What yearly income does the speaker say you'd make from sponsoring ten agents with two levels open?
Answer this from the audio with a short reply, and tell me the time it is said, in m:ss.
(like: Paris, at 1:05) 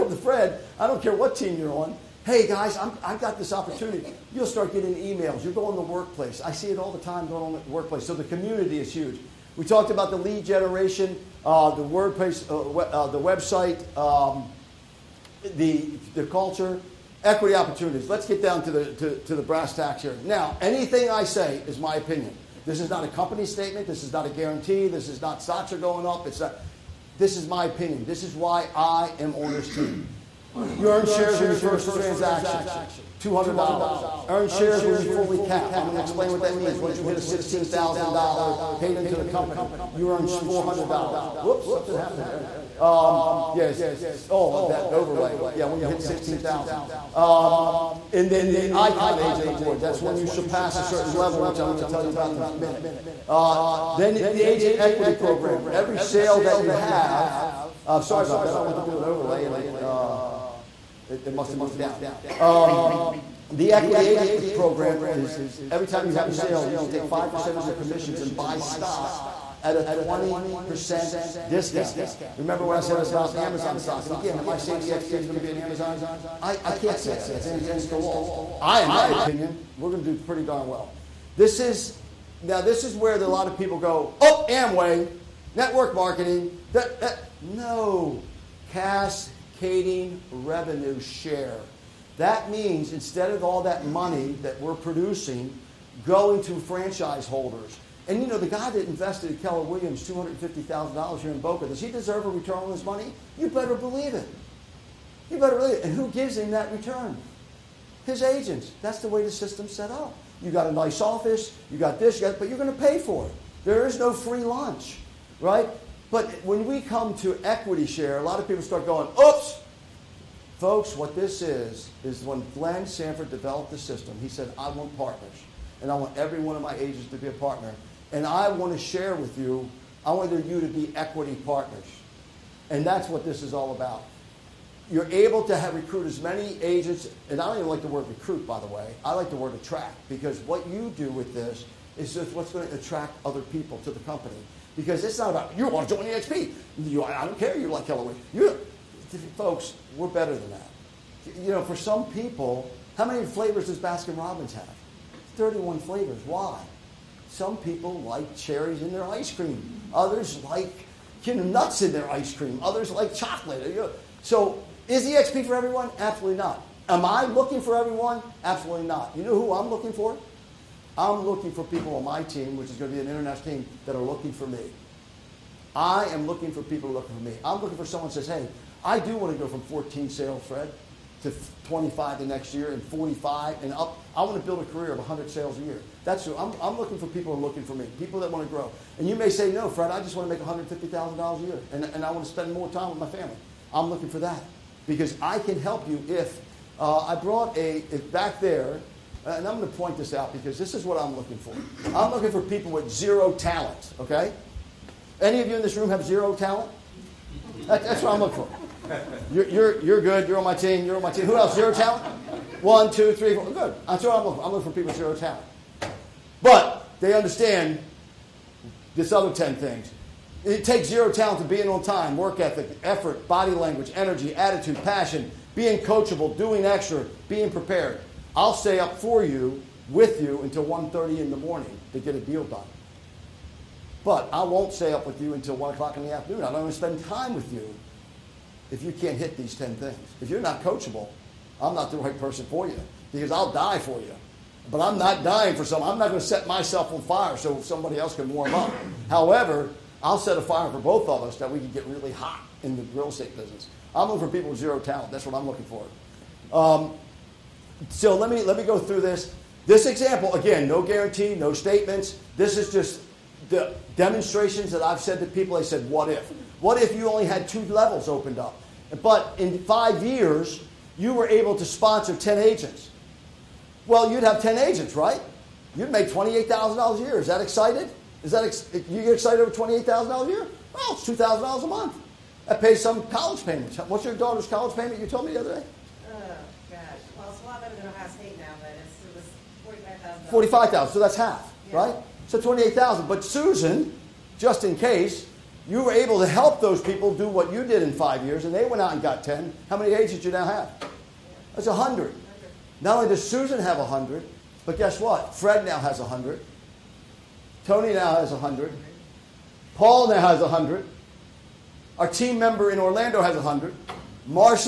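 $28,000, at 4:36.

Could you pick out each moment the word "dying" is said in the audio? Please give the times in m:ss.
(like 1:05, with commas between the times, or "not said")
4:05.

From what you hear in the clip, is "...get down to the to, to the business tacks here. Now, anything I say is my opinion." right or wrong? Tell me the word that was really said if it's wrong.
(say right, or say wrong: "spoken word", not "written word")
wrong: "brass", not "business".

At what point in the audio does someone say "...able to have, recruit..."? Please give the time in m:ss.
2:15.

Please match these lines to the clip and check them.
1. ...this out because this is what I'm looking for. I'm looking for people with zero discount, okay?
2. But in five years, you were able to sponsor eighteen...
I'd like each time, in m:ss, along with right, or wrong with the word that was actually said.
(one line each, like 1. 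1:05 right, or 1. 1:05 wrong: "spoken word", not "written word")
1. 3:19 wrong: "talent", not "discount"
2. 4:29 wrong: "ten", not "eighteen".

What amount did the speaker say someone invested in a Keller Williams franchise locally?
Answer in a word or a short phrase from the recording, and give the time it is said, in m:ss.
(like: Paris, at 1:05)
$250,000, at 1:40.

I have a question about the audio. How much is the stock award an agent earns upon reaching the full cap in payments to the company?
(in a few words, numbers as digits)
$400.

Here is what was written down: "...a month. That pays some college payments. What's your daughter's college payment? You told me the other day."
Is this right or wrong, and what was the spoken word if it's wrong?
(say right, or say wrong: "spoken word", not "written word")
right.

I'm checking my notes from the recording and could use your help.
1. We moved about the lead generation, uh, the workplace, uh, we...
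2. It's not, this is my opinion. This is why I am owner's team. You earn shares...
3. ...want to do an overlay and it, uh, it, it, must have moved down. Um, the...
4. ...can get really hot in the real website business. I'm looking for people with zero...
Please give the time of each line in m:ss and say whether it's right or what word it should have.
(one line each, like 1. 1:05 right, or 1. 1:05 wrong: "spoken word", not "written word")
1. 0:09 wrong: "talked", not "moved"
2. 0:26 right
3. 0:58 right
4. 4:11 wrong: "estate", not "website".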